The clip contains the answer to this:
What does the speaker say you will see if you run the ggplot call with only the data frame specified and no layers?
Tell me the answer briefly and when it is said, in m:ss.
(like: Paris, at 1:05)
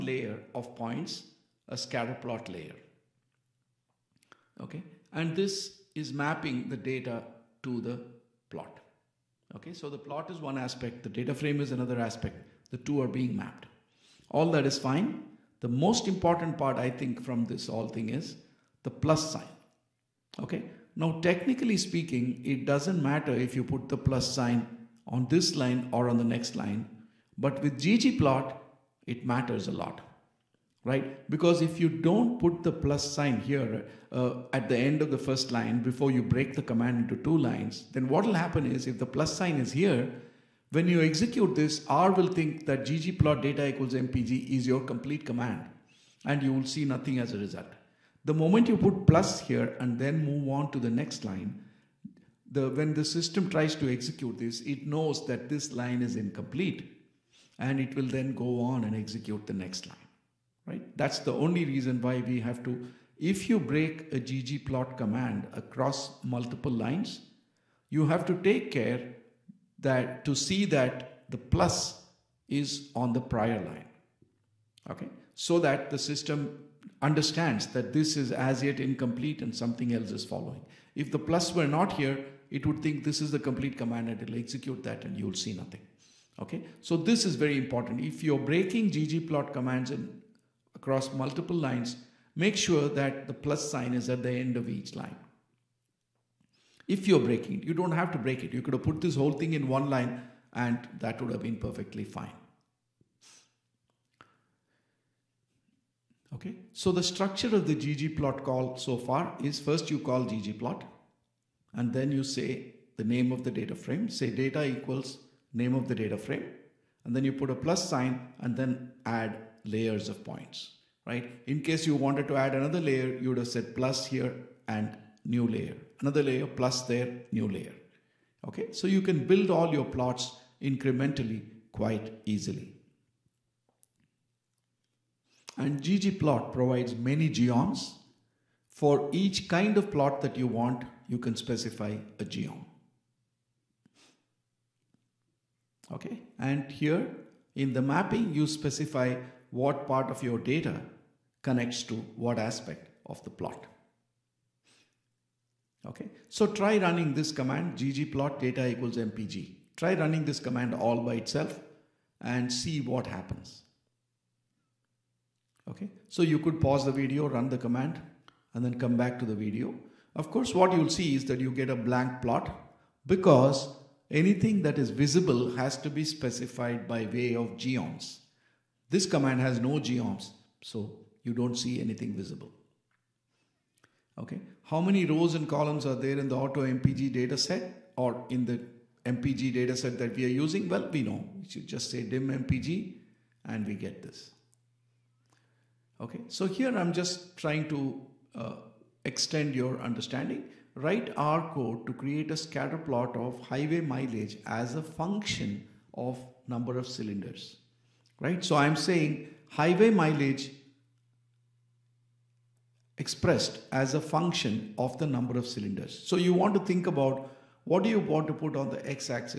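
a blank plot, at 2:51.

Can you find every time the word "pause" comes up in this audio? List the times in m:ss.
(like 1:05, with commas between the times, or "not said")
2:46.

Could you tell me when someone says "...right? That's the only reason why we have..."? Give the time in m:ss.
1:00.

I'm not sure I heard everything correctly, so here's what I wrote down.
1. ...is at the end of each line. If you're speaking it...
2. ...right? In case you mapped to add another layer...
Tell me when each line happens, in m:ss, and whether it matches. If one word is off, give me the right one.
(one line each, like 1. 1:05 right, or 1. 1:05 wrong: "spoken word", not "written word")
1. 1:33 wrong: "breaking", not "speaking"
2. 2:01 wrong: "wanted", not "mapped".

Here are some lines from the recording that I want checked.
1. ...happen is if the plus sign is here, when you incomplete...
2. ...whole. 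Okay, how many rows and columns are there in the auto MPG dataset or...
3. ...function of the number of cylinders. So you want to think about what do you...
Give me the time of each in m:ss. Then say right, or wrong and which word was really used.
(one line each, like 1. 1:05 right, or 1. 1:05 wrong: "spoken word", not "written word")
1. 0:38 wrong: "execute", not "incomplete"
2. 3:02 wrong: "visible", not "whole"
3. 3:33 right.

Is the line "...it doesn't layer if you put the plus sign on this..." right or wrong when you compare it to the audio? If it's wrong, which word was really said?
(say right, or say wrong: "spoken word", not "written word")
wrong: "matter", not "layer".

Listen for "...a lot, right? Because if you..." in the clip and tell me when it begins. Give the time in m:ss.
0:29.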